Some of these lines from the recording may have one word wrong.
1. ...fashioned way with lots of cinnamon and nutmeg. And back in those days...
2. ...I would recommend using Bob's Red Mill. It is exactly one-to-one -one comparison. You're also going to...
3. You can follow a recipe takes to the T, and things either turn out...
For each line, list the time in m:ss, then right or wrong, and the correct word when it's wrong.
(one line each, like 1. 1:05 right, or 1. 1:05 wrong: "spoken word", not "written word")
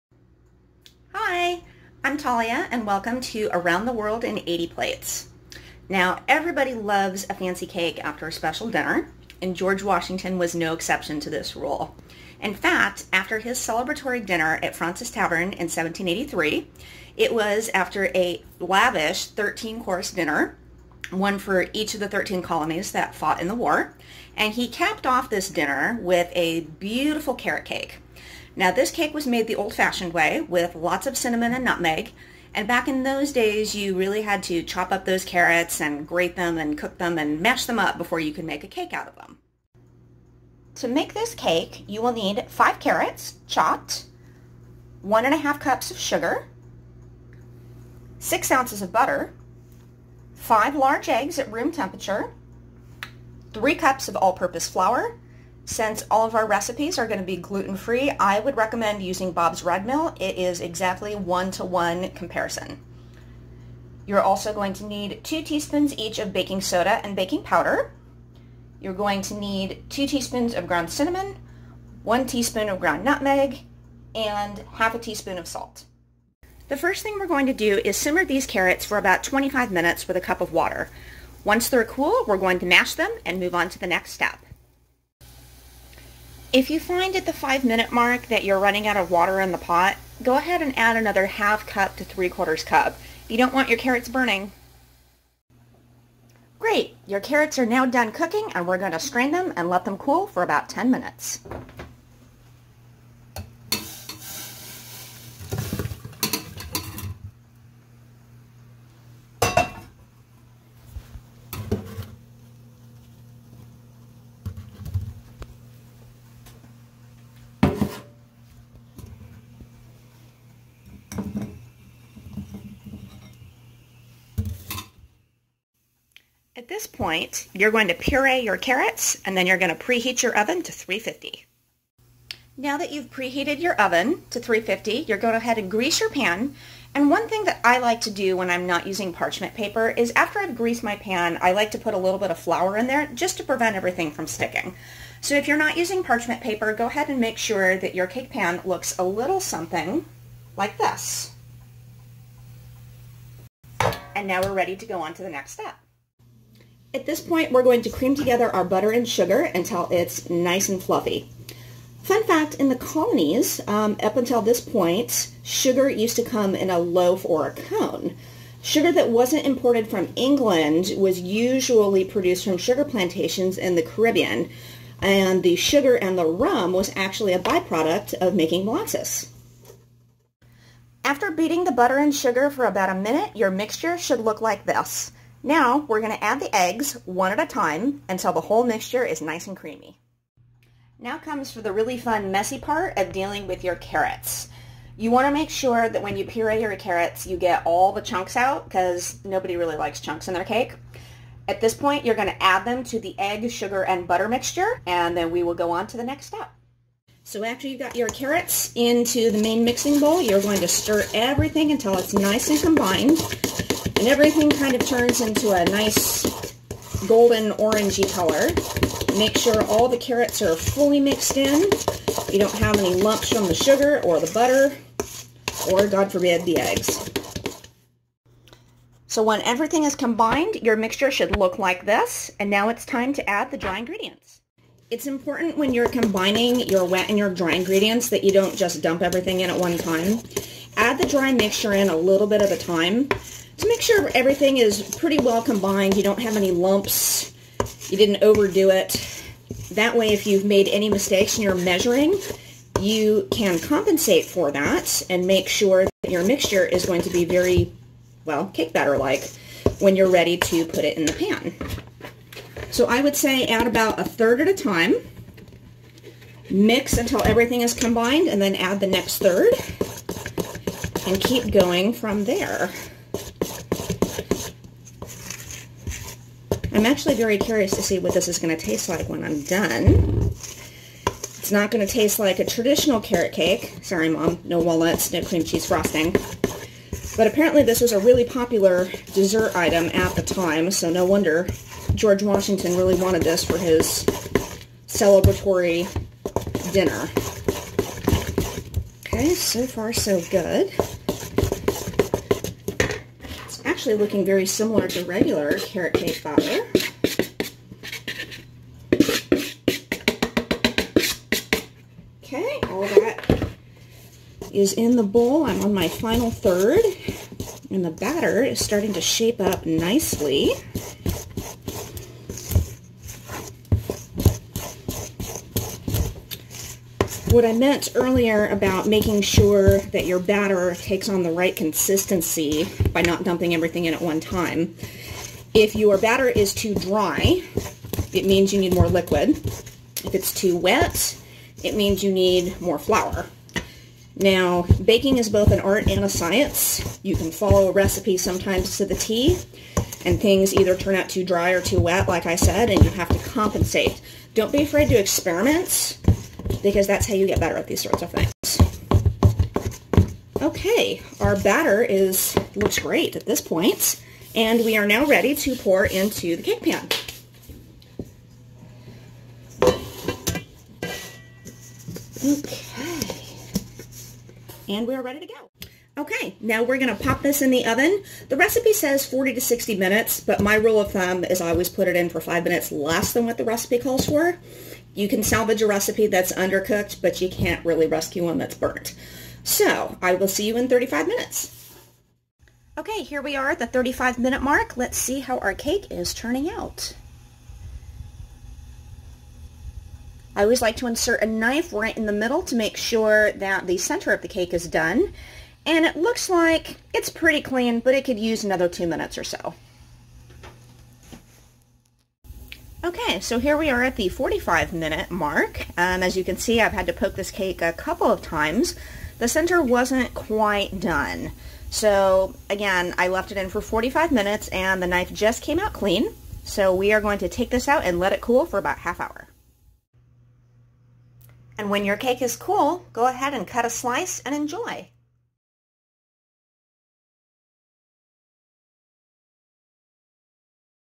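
1. 0:29 right
2. 0:58 right
3. 5:47 wrong: "sometimes", not "takes".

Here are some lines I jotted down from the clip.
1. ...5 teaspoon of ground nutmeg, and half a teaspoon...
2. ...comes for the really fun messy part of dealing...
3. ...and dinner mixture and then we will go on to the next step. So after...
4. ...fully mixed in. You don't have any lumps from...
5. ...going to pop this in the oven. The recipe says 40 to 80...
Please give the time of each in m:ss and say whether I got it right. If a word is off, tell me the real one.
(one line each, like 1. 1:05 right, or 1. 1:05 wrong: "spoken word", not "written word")
1. 1:12 wrong: "1", not "5"
2. 3:11 right
3. 3:23 wrong: "butter", not "dinner"
4. 3:40 right
5. 6:16 wrong: "60", not "80".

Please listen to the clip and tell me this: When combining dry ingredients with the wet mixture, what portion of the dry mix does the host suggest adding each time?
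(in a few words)
A third.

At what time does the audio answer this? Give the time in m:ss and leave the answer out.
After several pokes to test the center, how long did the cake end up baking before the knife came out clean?
7:03.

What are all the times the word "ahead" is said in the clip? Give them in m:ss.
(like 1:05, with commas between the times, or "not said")
1:30, 2:15, 2:26, 7:13.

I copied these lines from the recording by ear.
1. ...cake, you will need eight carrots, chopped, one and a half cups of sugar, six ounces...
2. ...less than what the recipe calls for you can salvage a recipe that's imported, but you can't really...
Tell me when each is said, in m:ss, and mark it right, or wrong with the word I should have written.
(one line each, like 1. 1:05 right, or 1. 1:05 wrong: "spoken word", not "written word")
1. 0:41 wrong: "five", not "eight"
2. 6:22 wrong: "undercooked", not "imported".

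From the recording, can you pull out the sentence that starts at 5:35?
If your batter is too dry, it means you need more liquid.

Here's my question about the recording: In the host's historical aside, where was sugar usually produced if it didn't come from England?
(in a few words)
The Caribbean.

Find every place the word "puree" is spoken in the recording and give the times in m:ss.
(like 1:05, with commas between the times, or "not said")
2:07, 3:16.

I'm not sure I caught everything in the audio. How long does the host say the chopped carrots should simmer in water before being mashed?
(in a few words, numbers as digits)
25 minutes.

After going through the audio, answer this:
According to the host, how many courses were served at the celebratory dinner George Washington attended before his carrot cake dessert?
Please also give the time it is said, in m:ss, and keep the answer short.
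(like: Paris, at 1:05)
13, at 0:19.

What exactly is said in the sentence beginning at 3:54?
It's important when you're combining your wet and your dry ingredients that you don't just dump everything in at one time.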